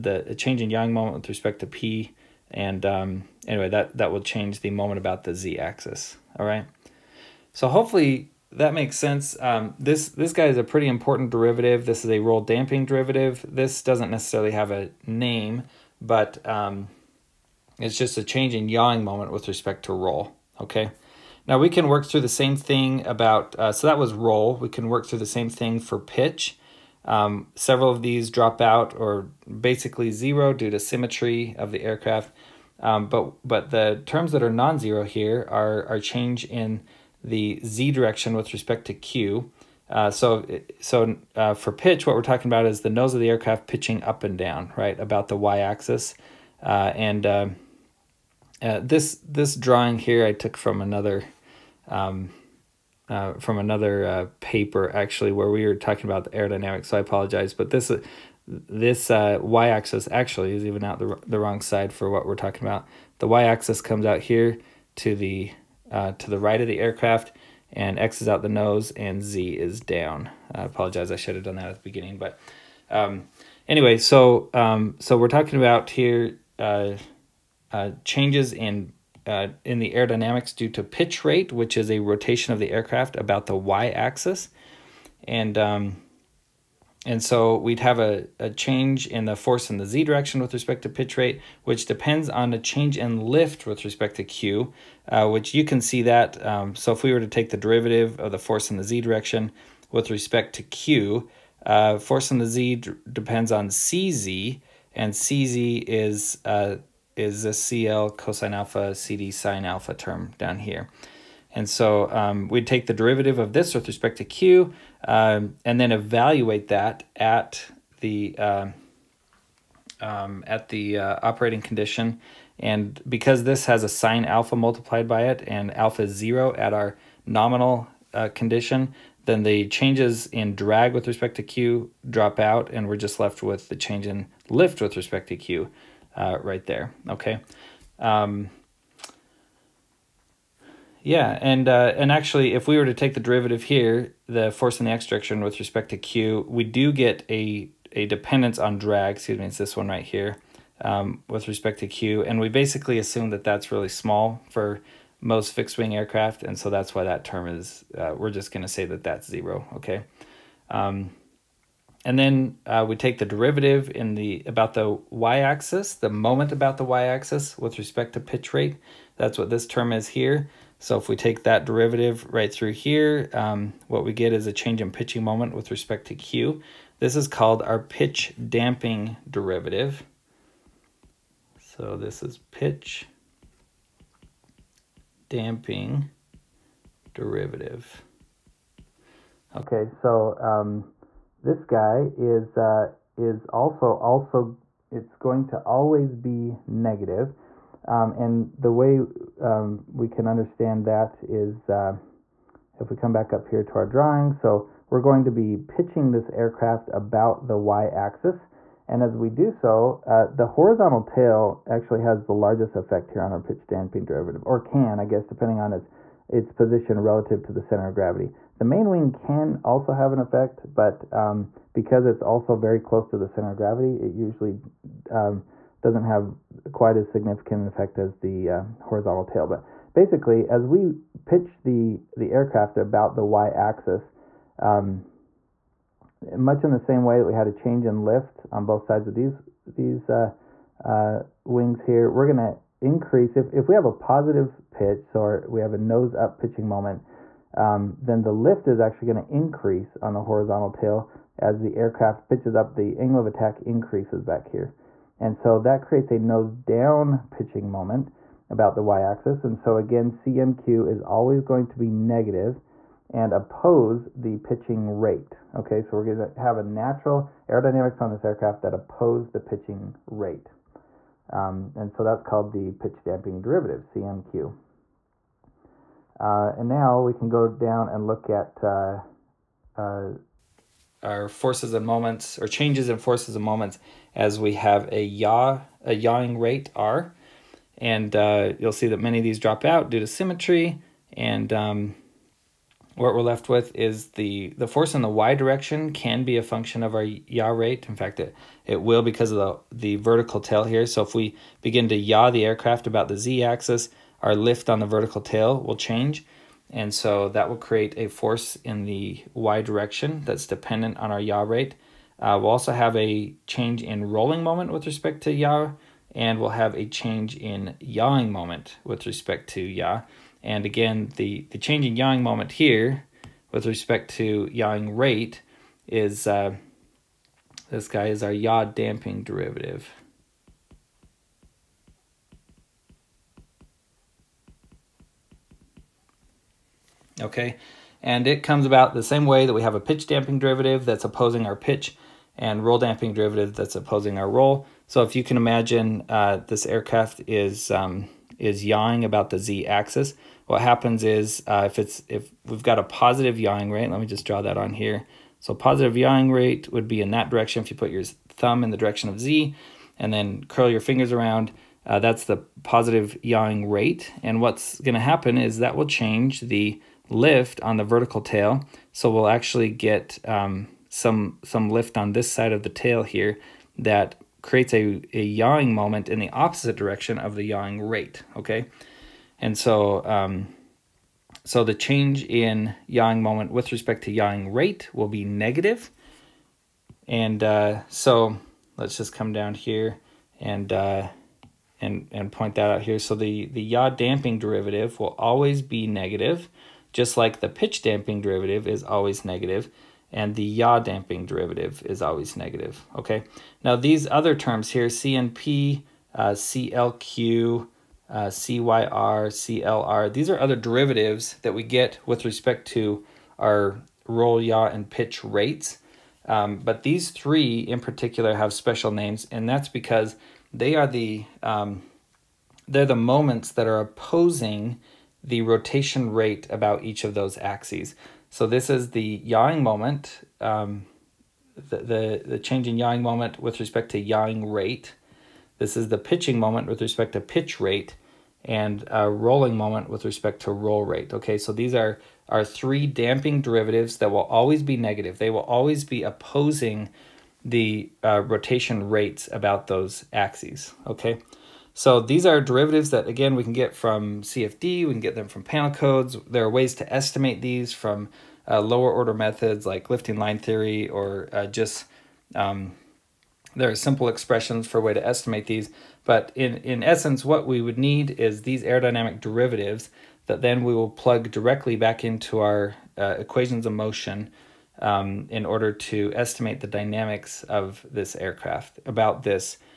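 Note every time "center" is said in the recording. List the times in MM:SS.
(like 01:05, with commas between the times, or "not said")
03:37, 03:43.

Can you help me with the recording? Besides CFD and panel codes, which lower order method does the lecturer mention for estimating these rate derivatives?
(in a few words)
Lifting line theory.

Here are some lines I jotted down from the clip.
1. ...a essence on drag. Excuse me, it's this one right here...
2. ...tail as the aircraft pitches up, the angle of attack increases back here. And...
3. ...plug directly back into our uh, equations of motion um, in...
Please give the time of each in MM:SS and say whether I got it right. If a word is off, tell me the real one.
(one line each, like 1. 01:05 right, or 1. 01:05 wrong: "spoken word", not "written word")
1. 02:27 wrong: "dependence", not "essence"
2. 04:10 right
3. 07:50 right.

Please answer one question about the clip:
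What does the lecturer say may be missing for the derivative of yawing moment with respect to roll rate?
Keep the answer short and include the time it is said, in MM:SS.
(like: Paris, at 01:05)
A name, at 00:13.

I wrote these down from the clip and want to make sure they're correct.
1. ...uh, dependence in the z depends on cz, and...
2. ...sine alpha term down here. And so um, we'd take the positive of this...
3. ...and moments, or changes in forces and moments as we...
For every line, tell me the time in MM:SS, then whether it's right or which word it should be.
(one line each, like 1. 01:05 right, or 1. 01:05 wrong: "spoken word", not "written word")
1. 01:41 wrong: "force", not "dependence"
2. 01:49 wrong: "derivative", not "positive"
3. 04:41 right.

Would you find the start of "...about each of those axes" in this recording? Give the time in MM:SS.
07:06.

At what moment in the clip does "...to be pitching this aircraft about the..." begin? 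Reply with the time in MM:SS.
03:25.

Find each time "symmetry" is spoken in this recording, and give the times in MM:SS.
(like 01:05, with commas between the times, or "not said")
00:30, 04:50.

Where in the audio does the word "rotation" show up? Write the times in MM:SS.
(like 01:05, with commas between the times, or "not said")
01:21, 07:05, 07:28.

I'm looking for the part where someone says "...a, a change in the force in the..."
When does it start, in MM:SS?
01:27.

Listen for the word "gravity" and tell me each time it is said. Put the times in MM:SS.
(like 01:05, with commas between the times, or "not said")
03:37, 03:43.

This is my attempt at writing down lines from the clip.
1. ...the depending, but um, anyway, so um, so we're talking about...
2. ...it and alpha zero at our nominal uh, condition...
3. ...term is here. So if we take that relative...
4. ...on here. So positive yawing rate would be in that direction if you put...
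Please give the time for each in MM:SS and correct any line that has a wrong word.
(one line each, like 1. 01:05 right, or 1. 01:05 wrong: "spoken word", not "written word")
1. 01:11 wrong: "beginning", not "depending"
2. 02:05 right
3. 02:49 wrong: "derivative", not "relative"
4. 05:54 right.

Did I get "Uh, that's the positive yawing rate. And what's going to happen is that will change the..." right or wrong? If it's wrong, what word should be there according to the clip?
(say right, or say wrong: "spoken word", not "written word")
right.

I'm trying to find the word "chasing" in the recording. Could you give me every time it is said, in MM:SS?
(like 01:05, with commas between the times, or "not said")
not said.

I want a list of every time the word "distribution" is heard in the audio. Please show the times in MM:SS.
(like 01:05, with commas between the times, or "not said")
not said.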